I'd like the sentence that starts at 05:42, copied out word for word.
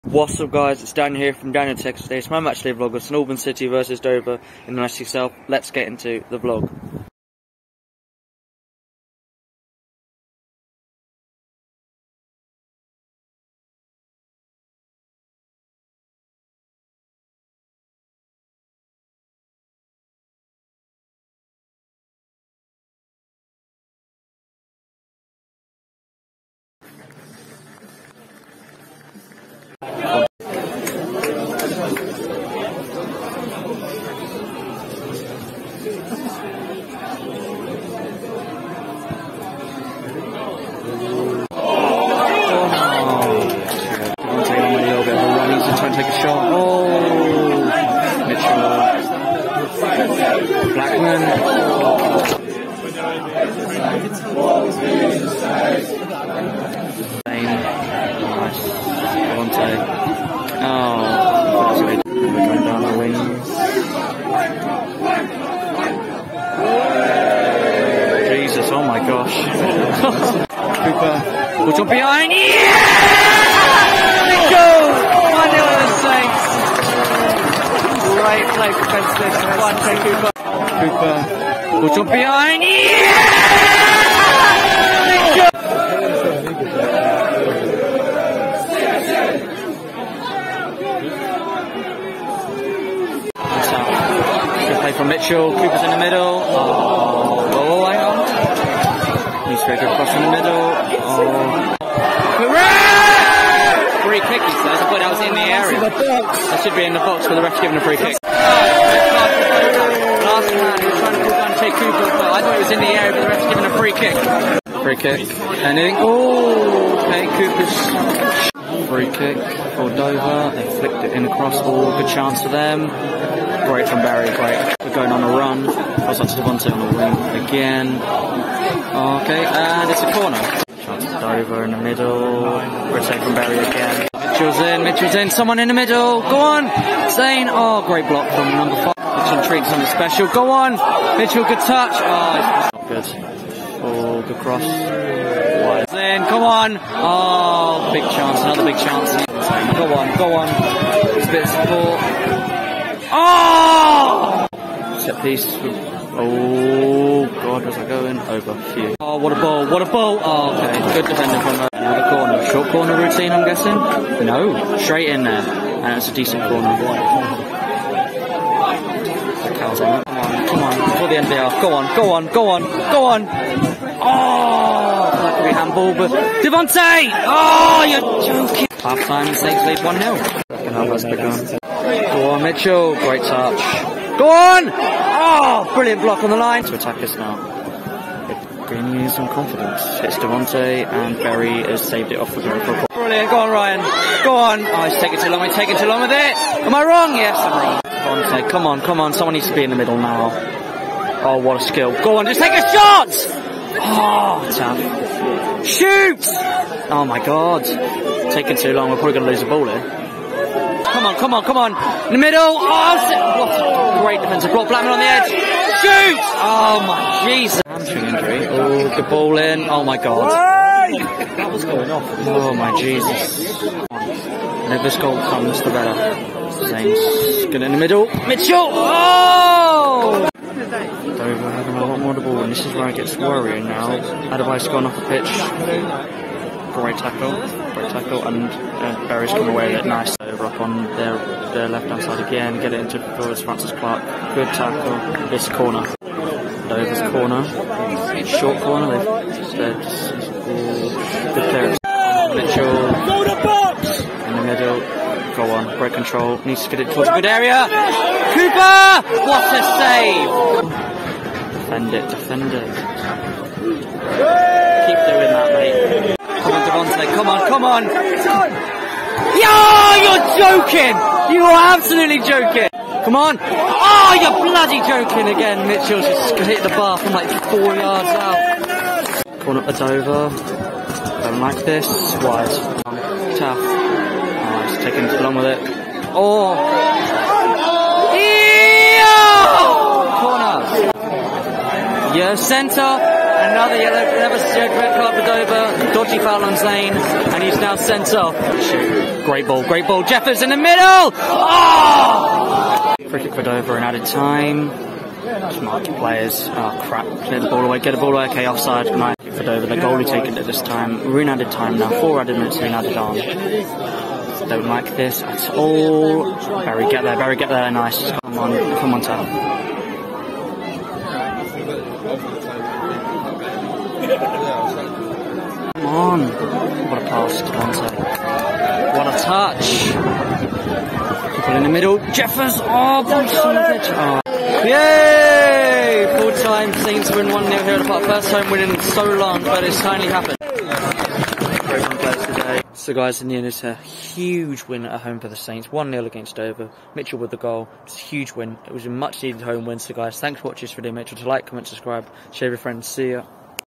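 So guys, in the end, it's a huge win at home for the Saints.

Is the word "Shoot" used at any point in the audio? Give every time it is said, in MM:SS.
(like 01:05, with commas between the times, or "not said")
03:25, 03:35.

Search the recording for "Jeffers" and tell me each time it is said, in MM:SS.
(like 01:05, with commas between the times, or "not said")
05:00, 05:32.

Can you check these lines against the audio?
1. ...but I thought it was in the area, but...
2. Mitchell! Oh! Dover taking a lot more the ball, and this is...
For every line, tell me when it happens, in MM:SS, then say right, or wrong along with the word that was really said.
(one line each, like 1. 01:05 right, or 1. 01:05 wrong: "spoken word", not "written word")
1. 01:52 right
2. 03:48 wrong: "having", not "taking".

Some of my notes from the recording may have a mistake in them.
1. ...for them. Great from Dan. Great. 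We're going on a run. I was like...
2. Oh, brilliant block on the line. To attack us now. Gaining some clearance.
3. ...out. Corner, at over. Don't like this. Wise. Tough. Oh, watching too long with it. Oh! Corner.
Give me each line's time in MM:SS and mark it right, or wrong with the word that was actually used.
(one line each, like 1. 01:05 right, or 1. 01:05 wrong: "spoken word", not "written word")
1. 02:02 wrong: "Barry", not "Dan"
2. 03:05 wrong: "confidence", not "clearance"
3. 04:38 wrong: "taking", not "watching".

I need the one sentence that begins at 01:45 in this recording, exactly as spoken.
That should be in the box, but the ref giving a free kick.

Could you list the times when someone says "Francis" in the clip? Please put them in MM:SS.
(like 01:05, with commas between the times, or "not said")
04:03.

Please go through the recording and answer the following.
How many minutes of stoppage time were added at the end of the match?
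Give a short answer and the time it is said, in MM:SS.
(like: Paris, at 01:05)
4, at 05:12.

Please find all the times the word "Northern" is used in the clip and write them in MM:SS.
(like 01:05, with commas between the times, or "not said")
00:03.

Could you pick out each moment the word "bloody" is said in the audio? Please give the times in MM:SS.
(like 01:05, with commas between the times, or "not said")
04:34.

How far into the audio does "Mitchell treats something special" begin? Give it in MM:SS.
02:18.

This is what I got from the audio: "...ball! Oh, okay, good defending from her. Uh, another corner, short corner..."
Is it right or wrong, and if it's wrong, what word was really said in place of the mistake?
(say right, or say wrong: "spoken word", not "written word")
right.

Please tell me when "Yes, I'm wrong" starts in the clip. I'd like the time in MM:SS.
03:17.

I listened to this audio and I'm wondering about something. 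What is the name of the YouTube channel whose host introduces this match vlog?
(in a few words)
Daniel Tekkerz.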